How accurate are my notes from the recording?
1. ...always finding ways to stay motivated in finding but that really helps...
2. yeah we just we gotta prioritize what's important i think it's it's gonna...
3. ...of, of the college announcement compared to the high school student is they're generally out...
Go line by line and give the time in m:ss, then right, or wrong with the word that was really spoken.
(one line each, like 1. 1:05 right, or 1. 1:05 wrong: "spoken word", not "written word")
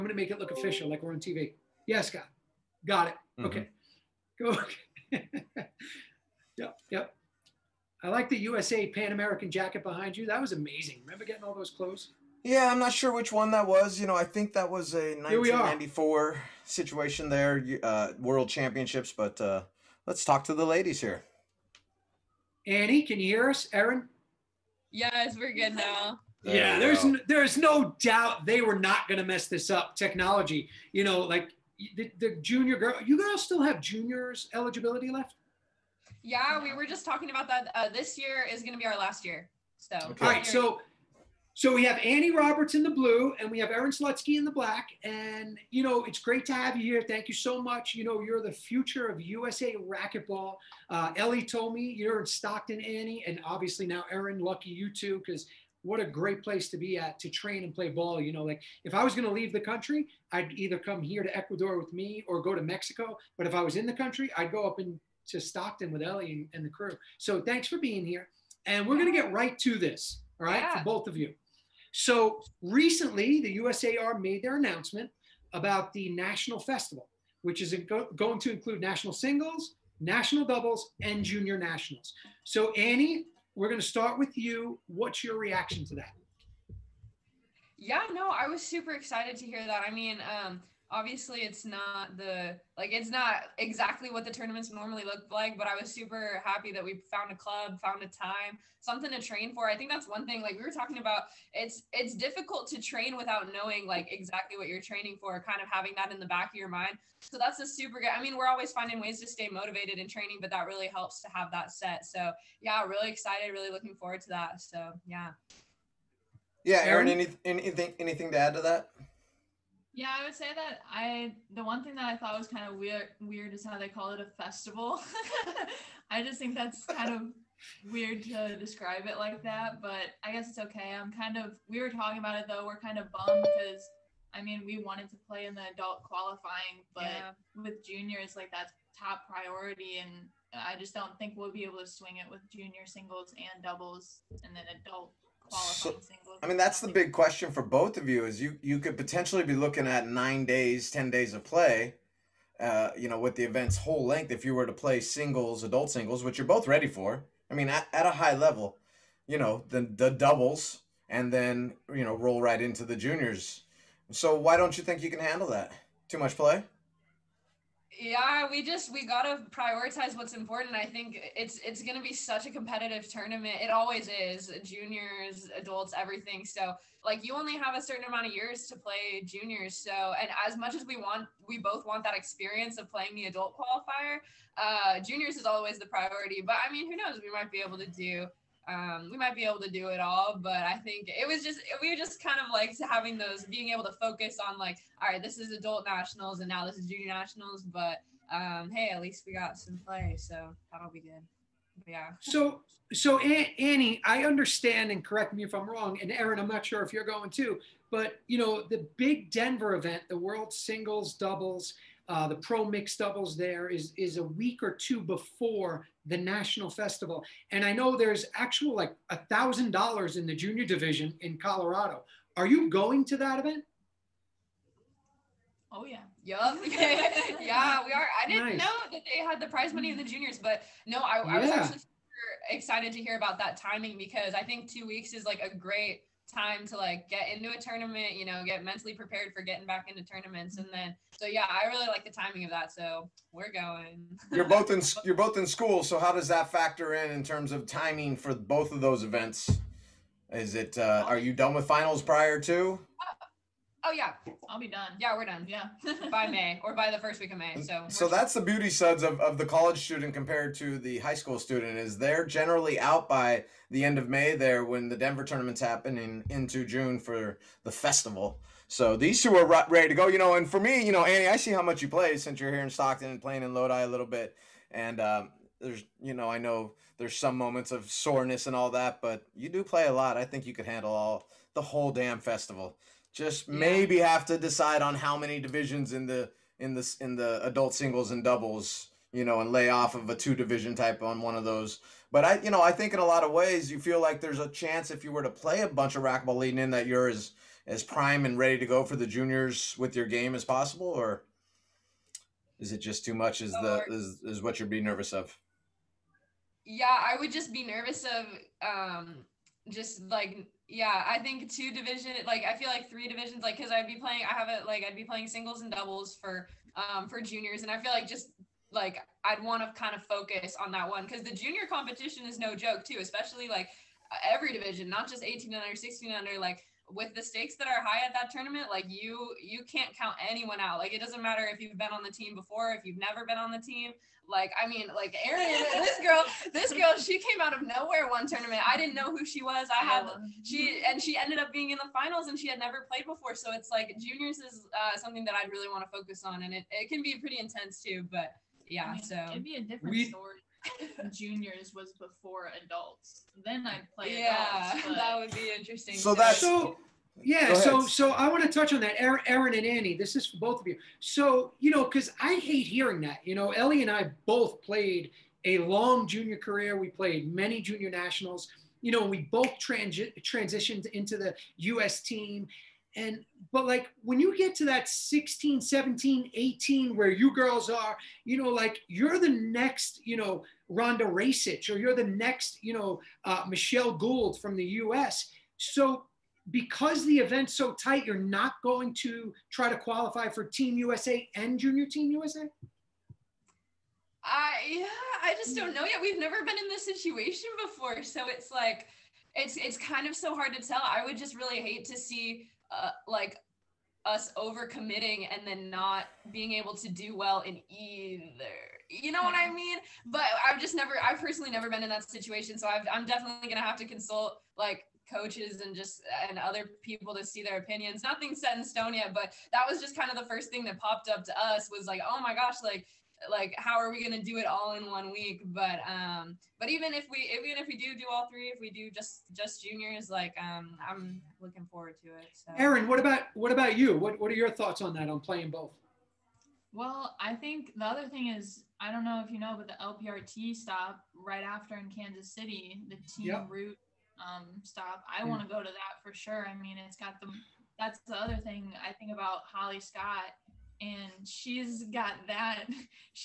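1. 1:48 wrong: "training", not "finding"
2. 2:47 right
3. 4:19 wrong: "student", not "announcement".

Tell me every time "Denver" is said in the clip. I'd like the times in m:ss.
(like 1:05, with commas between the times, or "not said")
3:29, 4:24.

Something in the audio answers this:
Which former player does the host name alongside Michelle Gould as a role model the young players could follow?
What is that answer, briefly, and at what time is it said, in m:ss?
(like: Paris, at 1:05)
Rhonda Rajsich, at 6:20.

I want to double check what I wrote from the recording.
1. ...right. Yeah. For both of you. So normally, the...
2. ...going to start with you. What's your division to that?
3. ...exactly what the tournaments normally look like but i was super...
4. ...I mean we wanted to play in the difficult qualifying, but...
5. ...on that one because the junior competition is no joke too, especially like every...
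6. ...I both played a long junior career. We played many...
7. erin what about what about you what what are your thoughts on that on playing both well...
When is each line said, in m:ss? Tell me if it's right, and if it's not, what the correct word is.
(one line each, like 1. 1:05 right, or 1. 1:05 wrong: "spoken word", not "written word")
1. 1:10 wrong: "recently", not "normally"
2. 1:23 wrong: "reaction", not "division"
3. 1:33 right
4. 2:14 wrong: "adult", not "difficult"
5. 5:20 right
6. 6:03 right
7. 7:12 right.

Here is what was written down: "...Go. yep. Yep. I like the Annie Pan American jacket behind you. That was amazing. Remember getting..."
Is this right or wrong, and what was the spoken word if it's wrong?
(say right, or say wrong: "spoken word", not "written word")
wrong: "USA", not "Annie".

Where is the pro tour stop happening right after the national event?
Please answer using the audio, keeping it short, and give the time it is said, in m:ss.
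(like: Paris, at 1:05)
Kansas City, at 7:21.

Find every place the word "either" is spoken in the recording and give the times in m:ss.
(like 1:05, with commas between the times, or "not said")
1:00, 6:47.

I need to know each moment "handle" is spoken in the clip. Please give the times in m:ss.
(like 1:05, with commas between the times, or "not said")
2:45, 4:40.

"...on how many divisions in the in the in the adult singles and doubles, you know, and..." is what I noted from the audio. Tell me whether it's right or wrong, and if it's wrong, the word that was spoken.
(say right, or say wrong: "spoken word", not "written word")
right.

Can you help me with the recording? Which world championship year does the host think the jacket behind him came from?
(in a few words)
1994.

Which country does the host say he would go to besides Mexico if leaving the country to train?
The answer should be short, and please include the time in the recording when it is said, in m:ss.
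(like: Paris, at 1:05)
Ecuador, at 1:01.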